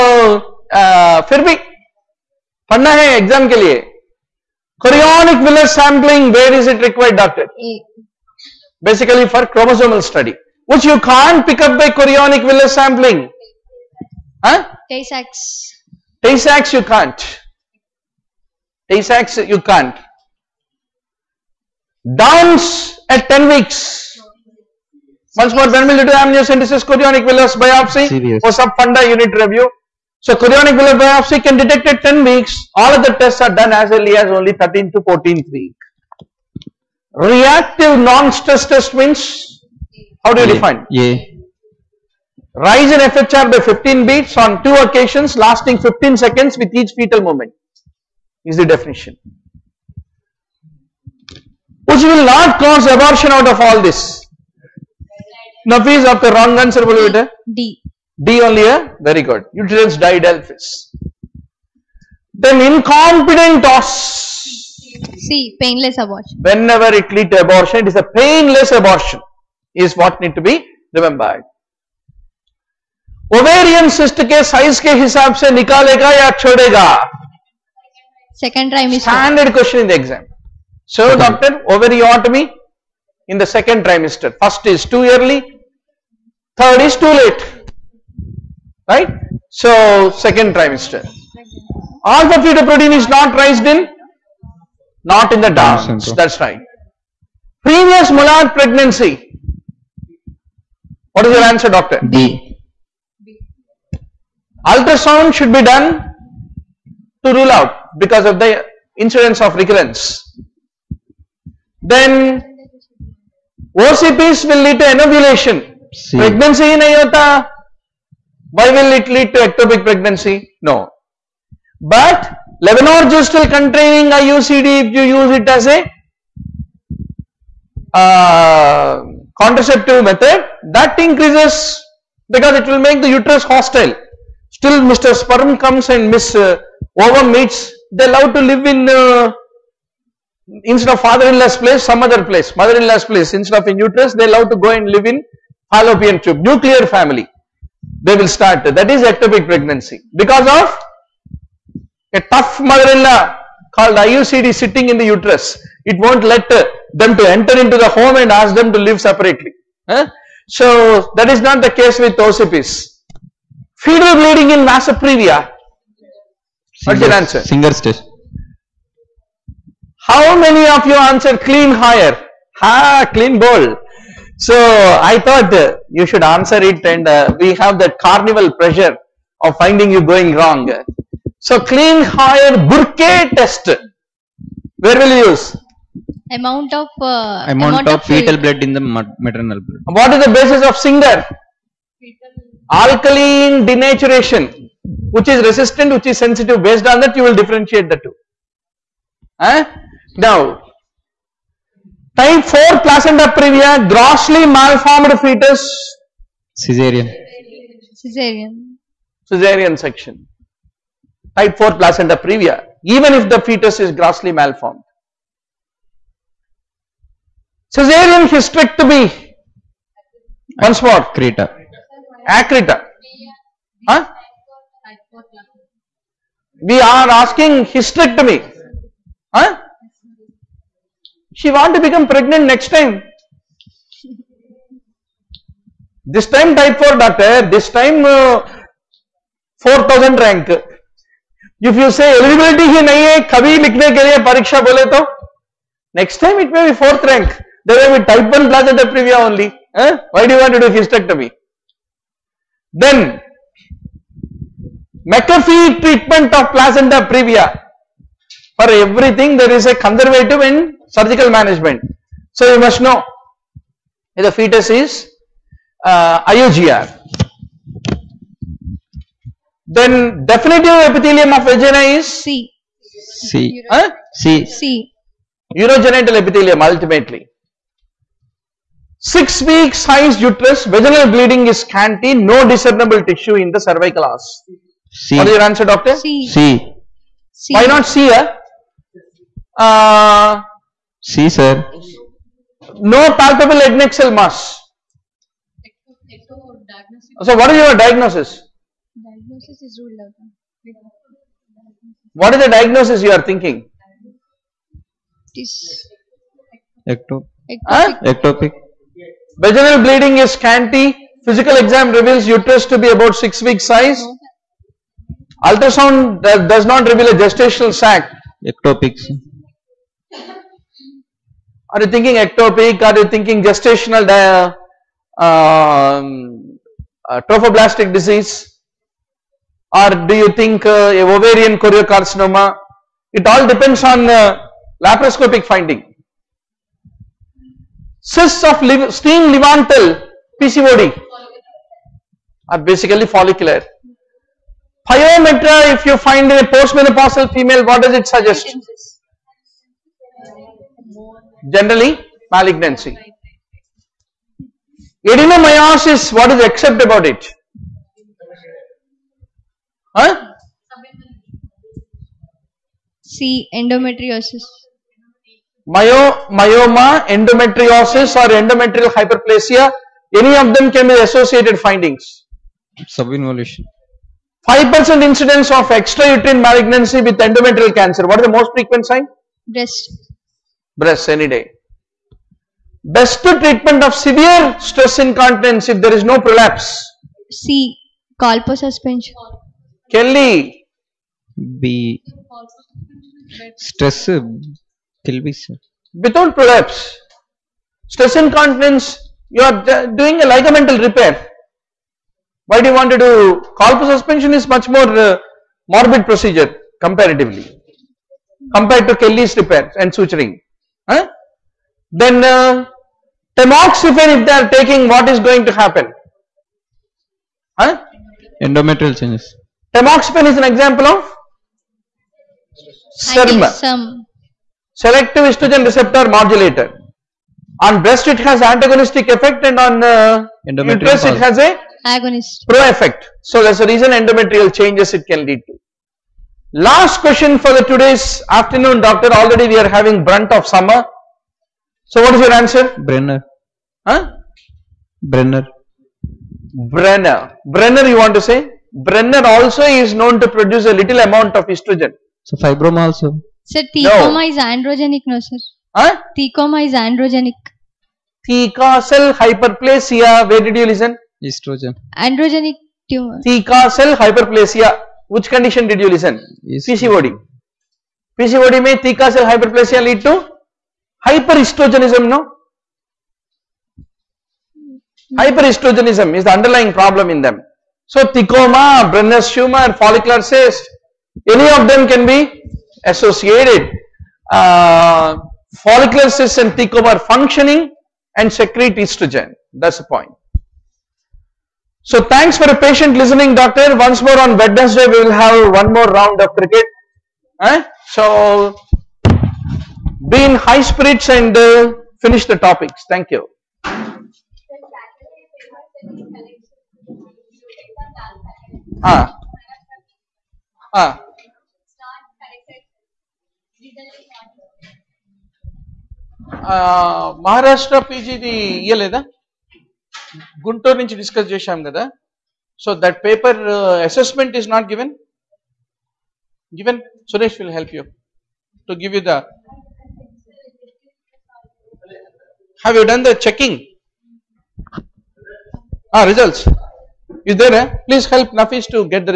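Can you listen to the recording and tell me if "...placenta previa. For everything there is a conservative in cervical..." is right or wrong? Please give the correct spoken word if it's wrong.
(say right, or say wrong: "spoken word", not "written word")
wrong: "surgical", not "cervical".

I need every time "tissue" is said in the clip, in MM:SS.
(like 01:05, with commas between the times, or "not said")
04:43.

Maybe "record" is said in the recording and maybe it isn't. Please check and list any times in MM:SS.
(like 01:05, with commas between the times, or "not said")
not said.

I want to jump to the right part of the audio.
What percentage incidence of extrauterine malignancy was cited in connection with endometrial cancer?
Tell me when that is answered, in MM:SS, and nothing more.
06:14.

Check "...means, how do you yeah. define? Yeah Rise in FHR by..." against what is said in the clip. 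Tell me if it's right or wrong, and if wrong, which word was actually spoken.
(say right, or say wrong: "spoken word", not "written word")
right.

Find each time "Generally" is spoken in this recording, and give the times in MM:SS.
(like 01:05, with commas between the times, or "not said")
05:51.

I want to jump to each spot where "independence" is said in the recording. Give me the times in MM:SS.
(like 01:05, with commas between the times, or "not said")
not said.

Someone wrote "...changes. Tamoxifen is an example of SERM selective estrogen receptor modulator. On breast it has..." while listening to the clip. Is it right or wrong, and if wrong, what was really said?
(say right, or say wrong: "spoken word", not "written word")
right.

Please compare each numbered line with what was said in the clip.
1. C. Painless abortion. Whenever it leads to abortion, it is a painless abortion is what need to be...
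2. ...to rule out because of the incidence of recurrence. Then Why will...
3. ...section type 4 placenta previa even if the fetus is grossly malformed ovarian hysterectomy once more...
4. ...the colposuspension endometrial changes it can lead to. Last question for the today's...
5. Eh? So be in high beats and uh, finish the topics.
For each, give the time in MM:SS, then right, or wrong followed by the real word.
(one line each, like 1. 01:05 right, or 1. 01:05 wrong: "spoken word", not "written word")
1. 01:05 right
2. 01:47 wrong: "OCPs", not "Why"
3. 03:29 wrong: "cesarean", not "ovarian"
4. 07:13 wrong: "reason", not "colposuspension"
5. 08:17 wrong: "spirits", not "beats".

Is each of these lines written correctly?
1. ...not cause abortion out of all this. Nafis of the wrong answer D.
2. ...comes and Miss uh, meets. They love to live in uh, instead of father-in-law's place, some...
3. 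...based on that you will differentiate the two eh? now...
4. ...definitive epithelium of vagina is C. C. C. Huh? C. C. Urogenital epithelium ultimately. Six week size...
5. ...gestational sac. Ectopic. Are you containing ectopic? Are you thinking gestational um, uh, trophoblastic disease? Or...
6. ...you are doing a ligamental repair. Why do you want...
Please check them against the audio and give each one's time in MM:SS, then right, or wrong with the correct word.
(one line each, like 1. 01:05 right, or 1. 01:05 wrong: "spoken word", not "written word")
1. 00:52 right
2. 02:15 right
3. 03:16 right
4. 04:30 right
5. 05:17 wrong: "thinking", not "containing"
6. 06:39 right.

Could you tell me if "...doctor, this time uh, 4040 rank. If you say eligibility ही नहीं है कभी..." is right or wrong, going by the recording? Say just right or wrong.
wrong.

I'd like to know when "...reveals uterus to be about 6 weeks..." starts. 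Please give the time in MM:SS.
05:11.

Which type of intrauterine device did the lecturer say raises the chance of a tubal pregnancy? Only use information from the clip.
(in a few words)
Levonorgestrel containing IUCD.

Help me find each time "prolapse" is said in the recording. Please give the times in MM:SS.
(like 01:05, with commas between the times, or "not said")
06:26, 06:36.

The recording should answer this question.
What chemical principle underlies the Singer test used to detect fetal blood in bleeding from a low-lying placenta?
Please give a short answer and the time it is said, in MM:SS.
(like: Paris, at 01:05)
Alkaline denaturation, at 03:12.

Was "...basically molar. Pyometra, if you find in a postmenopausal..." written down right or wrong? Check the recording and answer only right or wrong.
wrong.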